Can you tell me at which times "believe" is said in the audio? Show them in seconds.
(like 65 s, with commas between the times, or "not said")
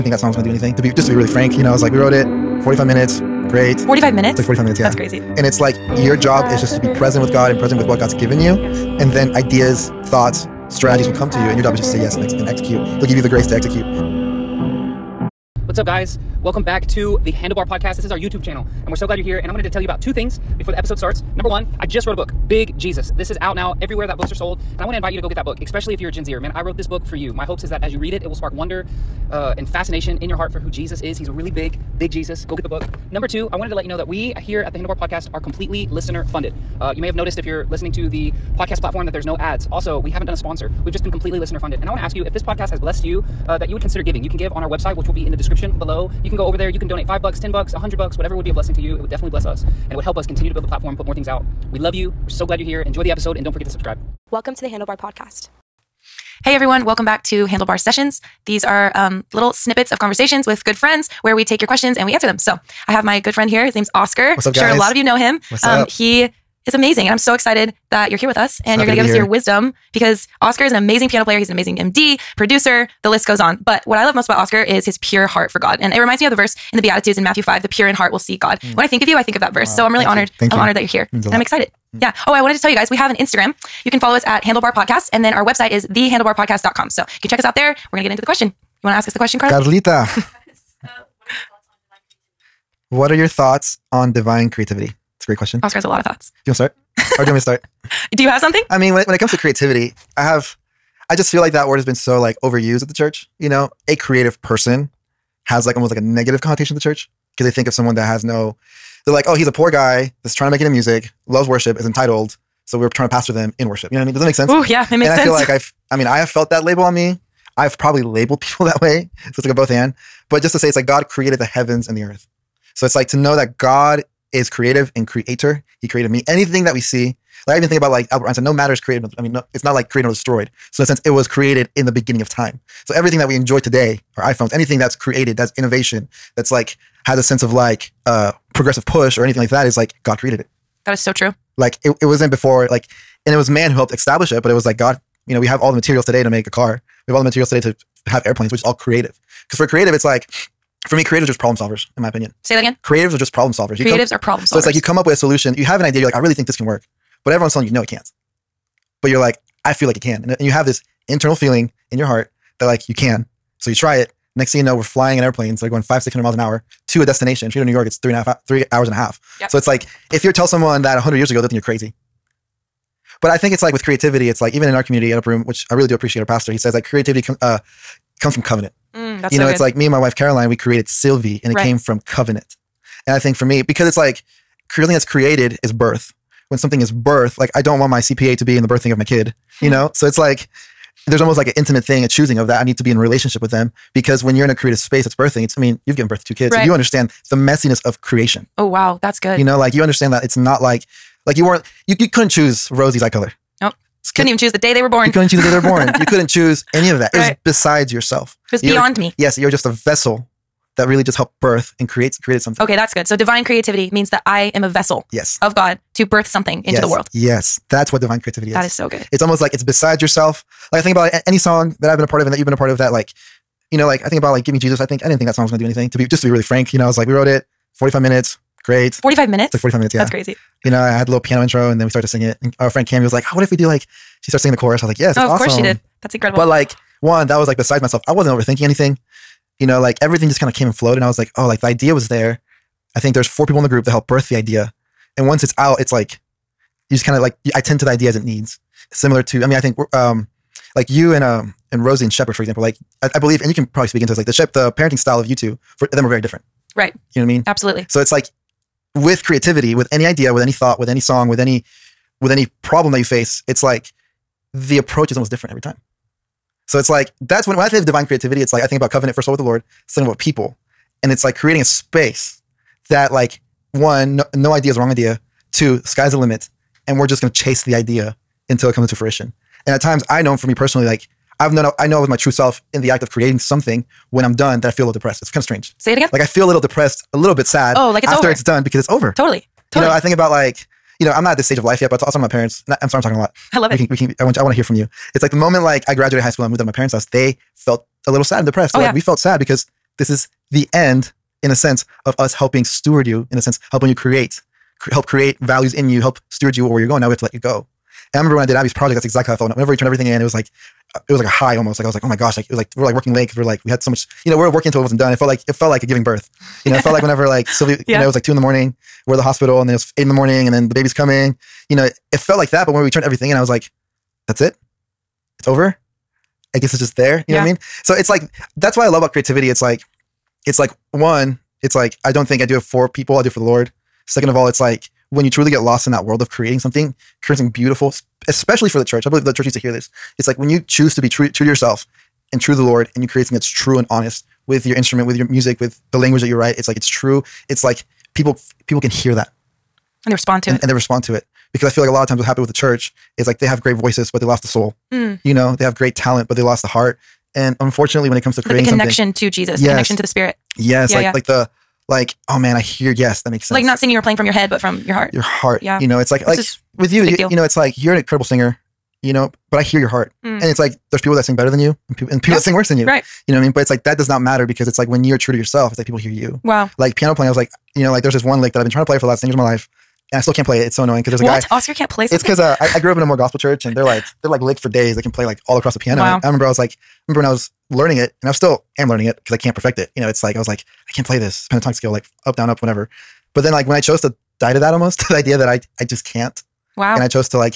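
253 s, 339 s.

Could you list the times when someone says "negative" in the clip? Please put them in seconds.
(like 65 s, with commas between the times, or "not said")
105 s.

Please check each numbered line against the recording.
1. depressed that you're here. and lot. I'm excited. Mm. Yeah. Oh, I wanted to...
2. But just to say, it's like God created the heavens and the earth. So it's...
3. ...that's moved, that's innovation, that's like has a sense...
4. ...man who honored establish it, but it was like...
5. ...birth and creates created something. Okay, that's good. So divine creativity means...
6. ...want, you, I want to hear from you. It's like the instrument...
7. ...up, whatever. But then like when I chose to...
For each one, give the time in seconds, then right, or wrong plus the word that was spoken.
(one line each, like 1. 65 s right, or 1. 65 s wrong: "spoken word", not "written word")
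1. 80 s wrong: "honored", not "depressed"
2. 120 s right
3. 134 s wrong: "created", not "moved"
4. 143 s wrong: "helped", not "honored"
5. 211 s right
6. 294 s wrong: "moment", not "instrument"
7. 392 s right.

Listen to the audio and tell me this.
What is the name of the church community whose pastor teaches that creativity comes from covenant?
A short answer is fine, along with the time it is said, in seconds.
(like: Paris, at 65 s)
Upper Room, at 175 s.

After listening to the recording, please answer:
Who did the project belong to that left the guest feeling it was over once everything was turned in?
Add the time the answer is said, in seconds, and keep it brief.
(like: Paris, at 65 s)
Abbie, at 308 s.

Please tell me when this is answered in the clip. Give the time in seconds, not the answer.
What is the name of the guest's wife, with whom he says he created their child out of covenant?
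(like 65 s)
180 s.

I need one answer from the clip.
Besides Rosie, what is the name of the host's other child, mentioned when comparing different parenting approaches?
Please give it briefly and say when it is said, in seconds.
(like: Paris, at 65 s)
Shepard, at 252 s.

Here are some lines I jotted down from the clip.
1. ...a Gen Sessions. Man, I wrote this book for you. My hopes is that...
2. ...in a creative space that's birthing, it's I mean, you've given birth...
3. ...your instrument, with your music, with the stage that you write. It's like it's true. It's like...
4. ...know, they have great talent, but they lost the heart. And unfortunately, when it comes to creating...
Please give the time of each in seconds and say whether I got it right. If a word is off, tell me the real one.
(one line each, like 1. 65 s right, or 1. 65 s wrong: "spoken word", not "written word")
1. 26 s wrong: "Zer", not "Sessions"
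2. 194 s right
3. 344 s wrong: "language", not "stage"
4. 355 s right.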